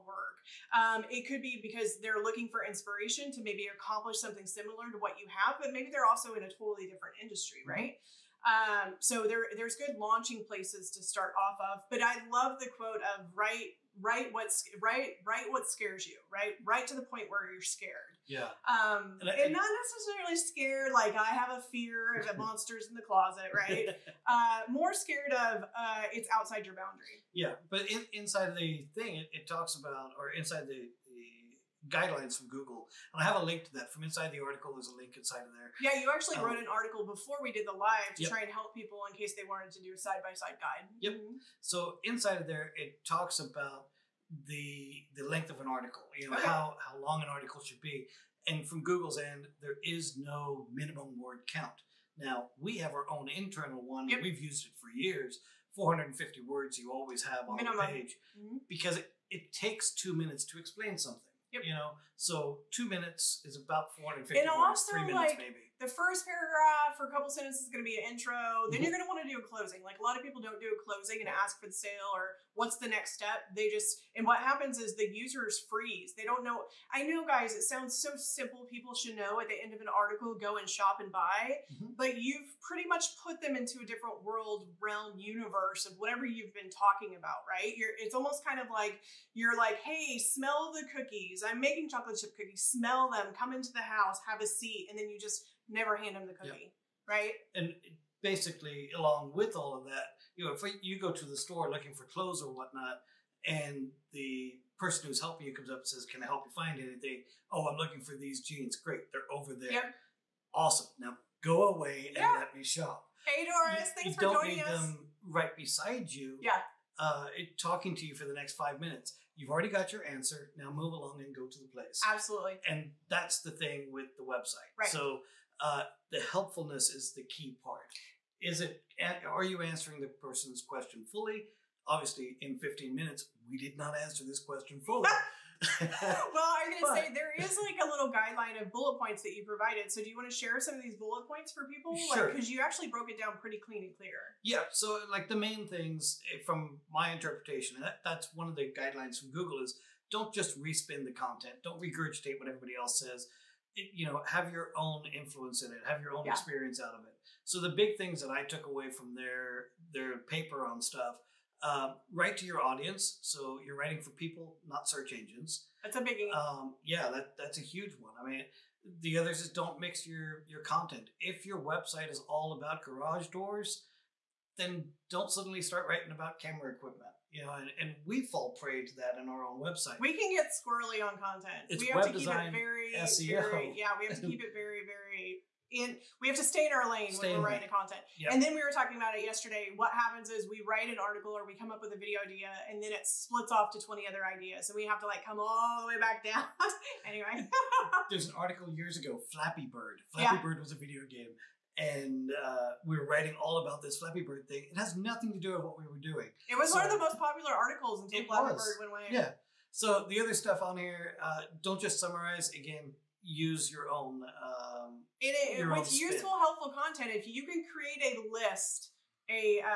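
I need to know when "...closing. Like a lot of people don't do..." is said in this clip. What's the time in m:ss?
1:09.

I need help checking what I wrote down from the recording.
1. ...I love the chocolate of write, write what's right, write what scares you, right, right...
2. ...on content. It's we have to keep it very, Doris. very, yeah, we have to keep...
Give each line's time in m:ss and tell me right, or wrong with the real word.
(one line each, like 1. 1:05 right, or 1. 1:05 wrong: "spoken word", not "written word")
1. 0:12 wrong: "quote", not "chocolate"
2. 3:01 wrong: "SEO", not "Doris".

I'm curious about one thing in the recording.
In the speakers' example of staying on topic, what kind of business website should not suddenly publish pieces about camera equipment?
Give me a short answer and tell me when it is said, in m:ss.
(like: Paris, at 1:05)
garage doors, at 2:52.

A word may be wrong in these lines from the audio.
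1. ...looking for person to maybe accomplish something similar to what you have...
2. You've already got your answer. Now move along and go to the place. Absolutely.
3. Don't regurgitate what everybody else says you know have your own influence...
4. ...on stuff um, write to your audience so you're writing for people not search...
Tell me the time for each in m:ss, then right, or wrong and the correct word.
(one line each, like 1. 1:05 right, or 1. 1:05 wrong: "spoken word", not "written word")
1. 0:02 wrong: "inspiration", not "person"
2. 1:59 right
3. 2:31 right
4. 2:40 right.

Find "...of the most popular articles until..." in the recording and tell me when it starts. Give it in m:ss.
3:26.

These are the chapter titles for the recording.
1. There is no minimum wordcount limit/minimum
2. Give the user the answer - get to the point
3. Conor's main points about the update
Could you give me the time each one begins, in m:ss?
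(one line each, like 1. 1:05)
1. 0:28
2. 1:36
3. 2:23.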